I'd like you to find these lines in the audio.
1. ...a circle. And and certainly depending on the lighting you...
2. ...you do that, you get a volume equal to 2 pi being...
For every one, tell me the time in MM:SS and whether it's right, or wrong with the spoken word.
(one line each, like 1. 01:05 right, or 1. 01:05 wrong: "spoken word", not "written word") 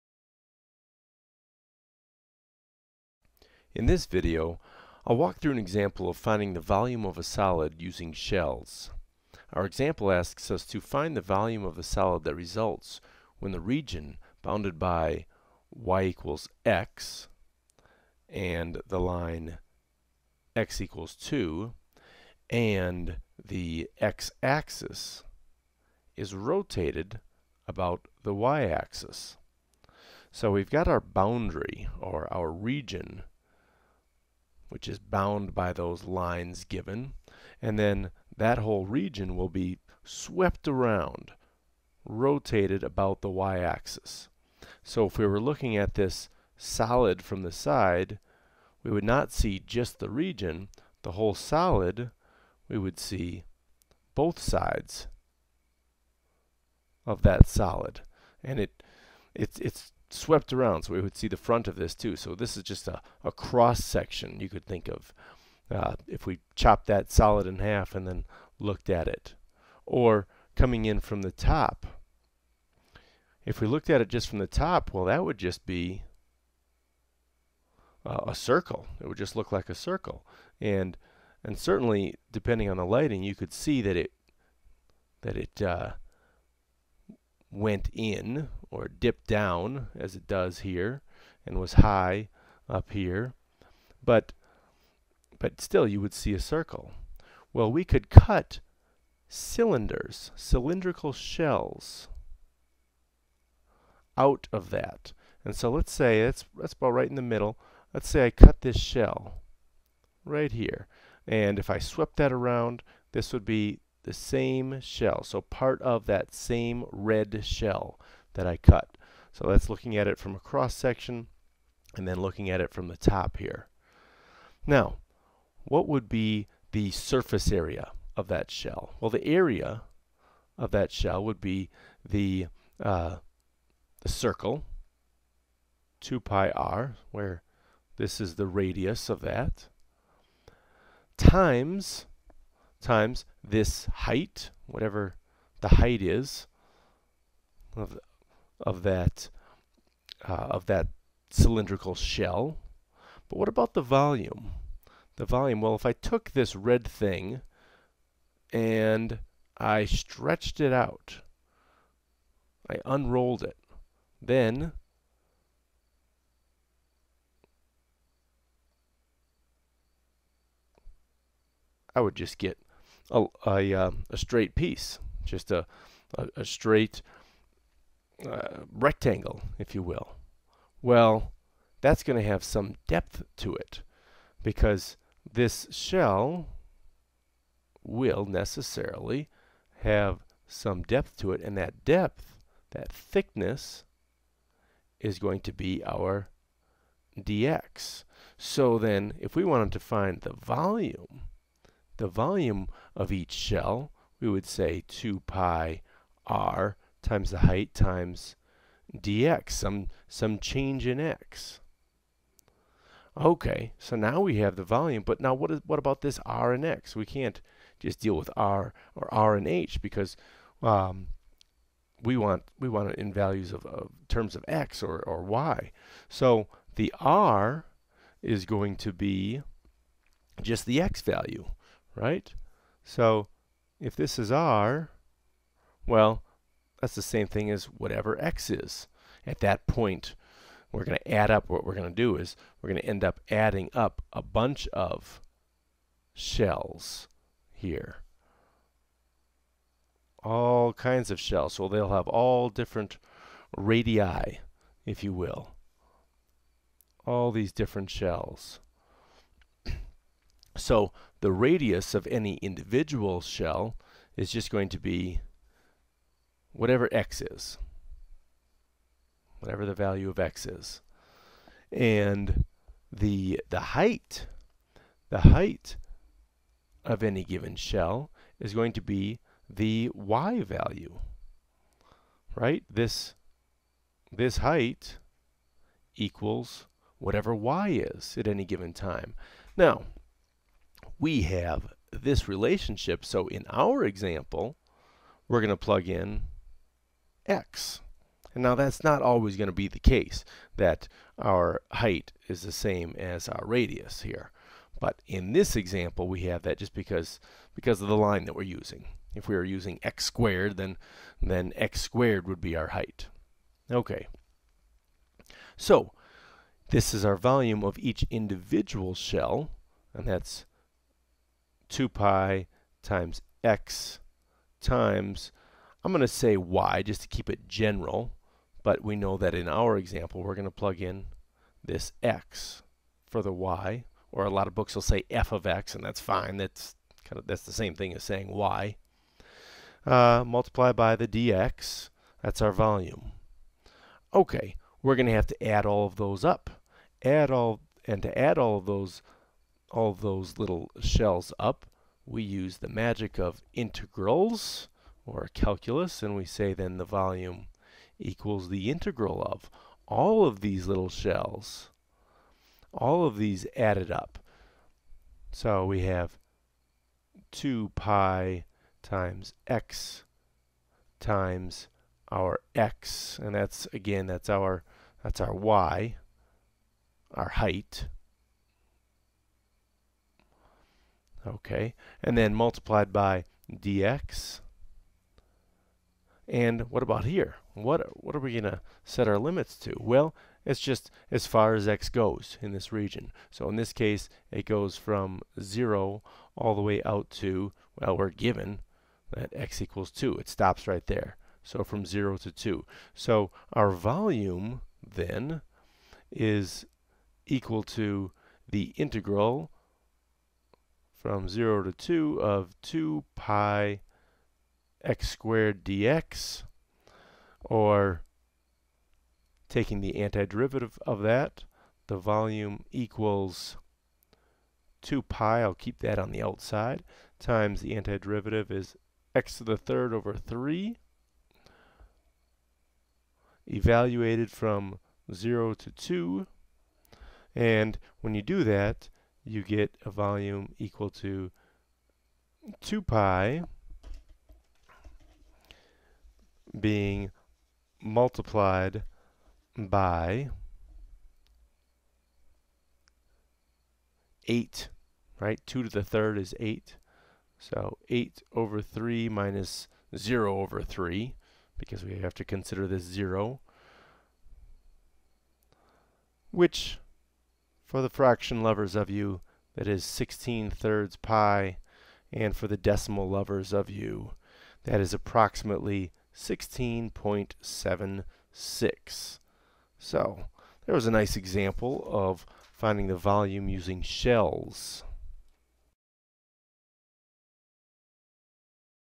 1. 01:19 right
2. 07:18 right.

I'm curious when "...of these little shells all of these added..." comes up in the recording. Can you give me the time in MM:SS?
06:00.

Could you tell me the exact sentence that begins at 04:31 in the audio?
And the, the height, the height of any given shell is going to be the y value, right?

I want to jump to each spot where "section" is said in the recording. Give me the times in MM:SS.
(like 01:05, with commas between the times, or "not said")
01:03, 02:00.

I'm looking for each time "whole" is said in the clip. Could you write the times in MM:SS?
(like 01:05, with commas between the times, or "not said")
00:38, 00:51.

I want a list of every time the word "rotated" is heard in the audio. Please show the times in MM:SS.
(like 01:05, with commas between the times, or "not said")
00:26, 00:42.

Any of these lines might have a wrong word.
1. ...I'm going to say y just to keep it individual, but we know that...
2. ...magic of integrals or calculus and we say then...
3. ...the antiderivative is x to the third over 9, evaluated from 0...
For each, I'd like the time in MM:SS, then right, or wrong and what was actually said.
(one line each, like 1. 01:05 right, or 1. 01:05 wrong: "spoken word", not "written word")
1. 05:25 wrong: "general", not "individual"
2. 05:52 right
3. 07:07 wrong: "3", not "9".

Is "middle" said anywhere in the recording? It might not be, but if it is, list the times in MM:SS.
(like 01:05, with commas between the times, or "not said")
01:47.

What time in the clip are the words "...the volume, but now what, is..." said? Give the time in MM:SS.
03:34.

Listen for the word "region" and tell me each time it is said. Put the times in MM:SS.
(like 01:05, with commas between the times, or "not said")
00:13, 00:32, 00:38, 00:50, 06:32.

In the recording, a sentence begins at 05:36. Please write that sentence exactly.
That's kind of that's the same thing as saying y.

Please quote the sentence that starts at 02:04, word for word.
Now, what would be the surface area of that shell?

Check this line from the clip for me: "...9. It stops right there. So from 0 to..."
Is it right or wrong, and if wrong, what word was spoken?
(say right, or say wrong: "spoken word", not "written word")
wrong: "2", not "9".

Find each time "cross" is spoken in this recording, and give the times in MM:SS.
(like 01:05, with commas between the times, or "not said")
01:03, 02:00.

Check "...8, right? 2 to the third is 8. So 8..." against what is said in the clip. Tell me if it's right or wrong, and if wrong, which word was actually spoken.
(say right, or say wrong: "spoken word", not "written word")
right.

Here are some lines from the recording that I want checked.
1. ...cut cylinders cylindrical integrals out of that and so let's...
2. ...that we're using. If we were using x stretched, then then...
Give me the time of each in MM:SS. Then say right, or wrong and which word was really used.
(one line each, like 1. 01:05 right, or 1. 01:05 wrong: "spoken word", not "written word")
1. 01:38 wrong: "shells", not "integrals"
2. 05:08 wrong: "squared", not "stretched".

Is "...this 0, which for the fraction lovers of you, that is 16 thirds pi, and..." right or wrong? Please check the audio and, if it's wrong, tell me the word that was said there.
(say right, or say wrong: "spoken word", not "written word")
right.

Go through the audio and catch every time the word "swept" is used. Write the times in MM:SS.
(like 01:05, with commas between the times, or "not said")
00:40, 01:00, 01:51.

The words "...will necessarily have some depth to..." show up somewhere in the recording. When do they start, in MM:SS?
03:07.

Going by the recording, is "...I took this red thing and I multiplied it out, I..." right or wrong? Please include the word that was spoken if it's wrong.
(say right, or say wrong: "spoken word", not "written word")
wrong: "stretched", not "multiplied".